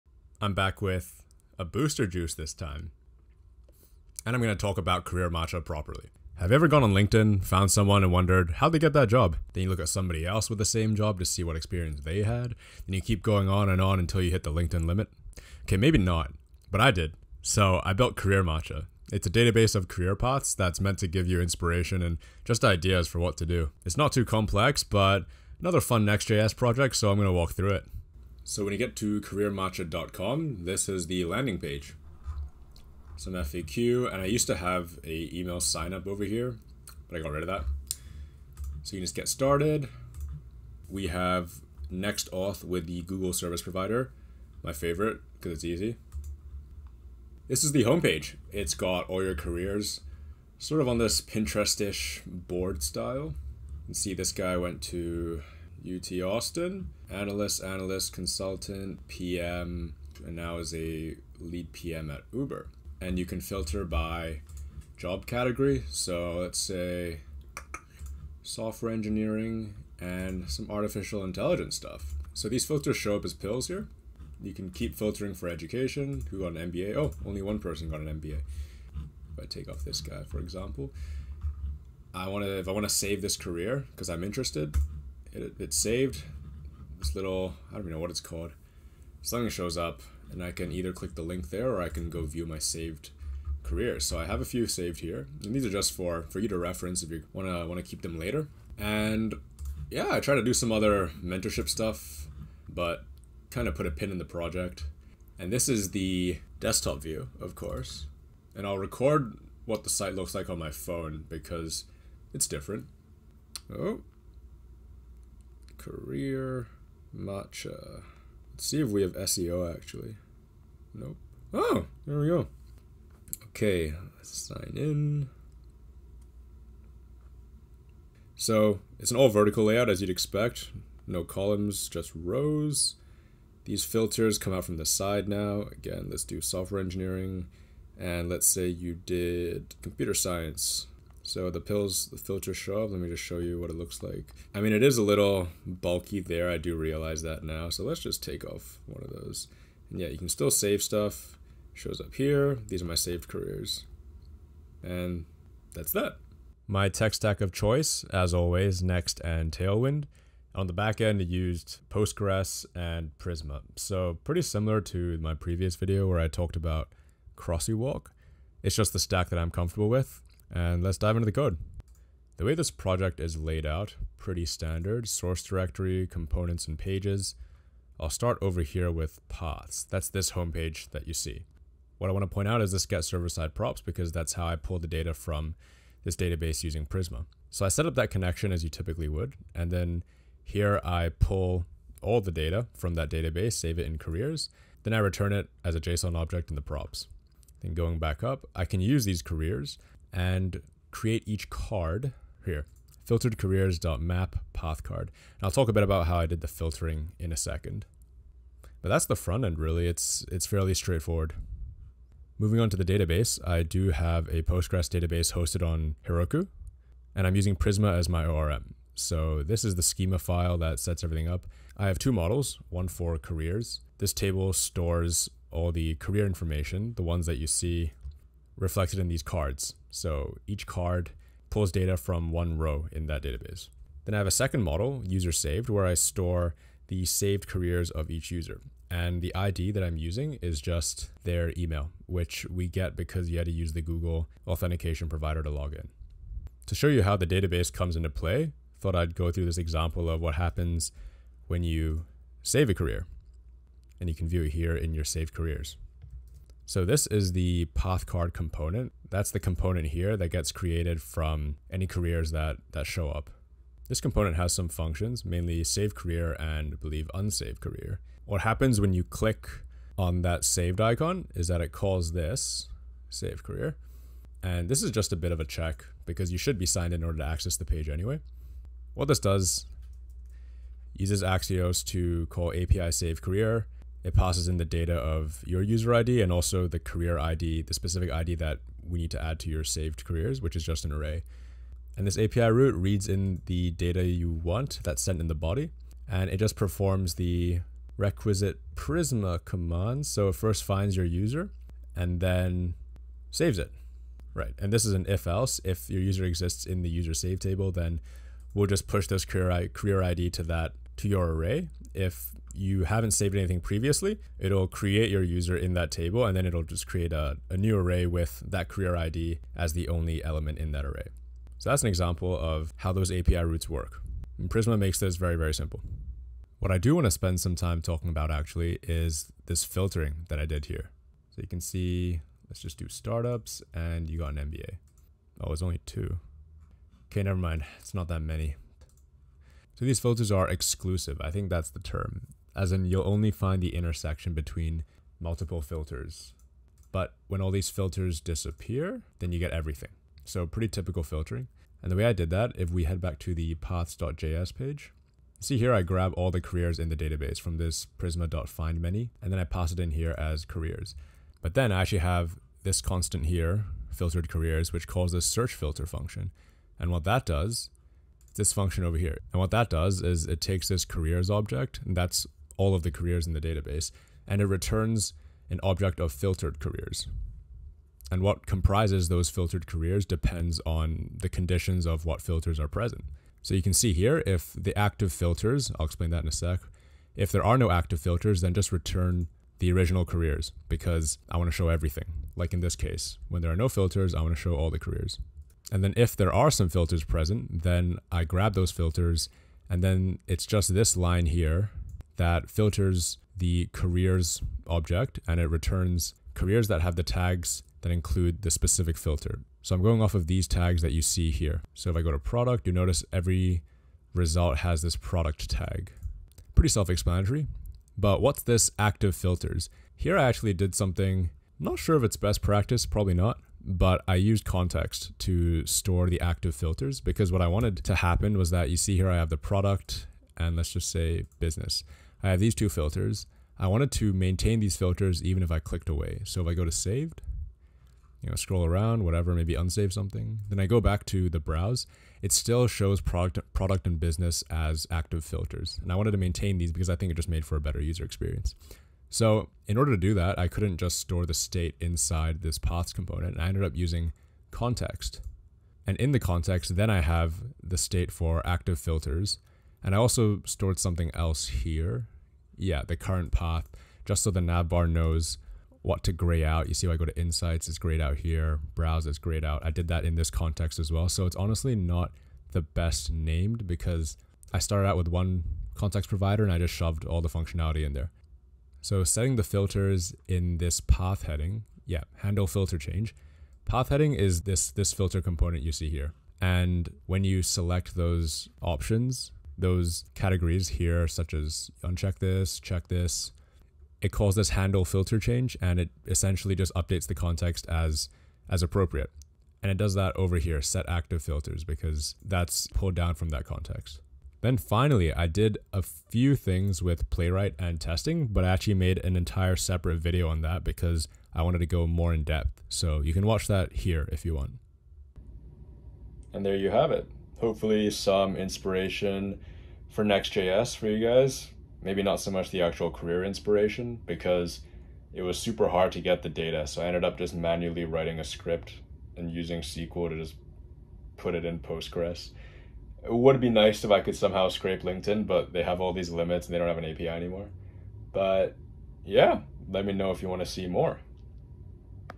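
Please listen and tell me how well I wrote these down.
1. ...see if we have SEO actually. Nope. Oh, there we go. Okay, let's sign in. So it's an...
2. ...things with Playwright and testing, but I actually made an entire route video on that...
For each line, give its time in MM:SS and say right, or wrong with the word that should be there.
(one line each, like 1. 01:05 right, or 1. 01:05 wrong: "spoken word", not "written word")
1. 01:58 right
2. 08:26 wrong: "separate", not "route".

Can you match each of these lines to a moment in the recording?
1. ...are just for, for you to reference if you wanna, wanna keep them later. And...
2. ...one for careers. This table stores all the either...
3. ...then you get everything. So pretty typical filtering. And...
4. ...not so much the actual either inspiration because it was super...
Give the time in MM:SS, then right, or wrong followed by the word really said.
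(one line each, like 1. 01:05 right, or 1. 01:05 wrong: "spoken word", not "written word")
1. 01:35 right
2. 03:42 wrong: "career", not "either"
3. 05:49 right
4. 08:42 wrong: "career", not "either".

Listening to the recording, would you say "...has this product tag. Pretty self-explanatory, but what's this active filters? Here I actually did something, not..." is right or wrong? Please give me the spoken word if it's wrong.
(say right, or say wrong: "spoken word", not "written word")
right.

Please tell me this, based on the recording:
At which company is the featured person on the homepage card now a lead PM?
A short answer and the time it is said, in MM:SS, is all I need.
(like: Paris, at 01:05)
Uber, at 01:02.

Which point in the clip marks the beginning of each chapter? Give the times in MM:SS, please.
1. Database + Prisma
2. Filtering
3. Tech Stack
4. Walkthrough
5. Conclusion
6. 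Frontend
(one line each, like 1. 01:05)
1. 03:32
2. 05:26
3. 02:36
4. 00:28
5. 08:35
6. 02:53.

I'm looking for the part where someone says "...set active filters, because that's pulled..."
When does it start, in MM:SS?
08:20.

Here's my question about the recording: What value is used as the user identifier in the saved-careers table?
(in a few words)
Their email.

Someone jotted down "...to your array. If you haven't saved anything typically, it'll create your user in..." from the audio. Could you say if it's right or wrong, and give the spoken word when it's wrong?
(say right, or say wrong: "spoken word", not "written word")
wrong: "previously", not "typically".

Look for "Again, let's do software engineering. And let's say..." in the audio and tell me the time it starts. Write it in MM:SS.
02:15.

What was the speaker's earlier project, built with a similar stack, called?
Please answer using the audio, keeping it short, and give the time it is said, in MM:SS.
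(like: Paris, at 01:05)
CrossyWalk, at 02:47.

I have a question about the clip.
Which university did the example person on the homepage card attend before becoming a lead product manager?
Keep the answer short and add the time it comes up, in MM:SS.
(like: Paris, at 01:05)
UT Austin, at 00:55.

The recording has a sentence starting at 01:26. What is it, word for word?
This little, I don't even know what it's called.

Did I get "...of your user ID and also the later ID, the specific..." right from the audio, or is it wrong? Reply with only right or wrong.
wrong.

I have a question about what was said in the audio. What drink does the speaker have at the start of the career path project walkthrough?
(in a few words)
Booster Juice.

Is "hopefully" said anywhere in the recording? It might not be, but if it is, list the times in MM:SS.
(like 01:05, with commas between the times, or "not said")
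08:37.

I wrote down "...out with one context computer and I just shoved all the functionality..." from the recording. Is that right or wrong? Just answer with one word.
wrong.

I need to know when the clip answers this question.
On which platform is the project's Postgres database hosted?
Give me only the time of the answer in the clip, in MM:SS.
03:36.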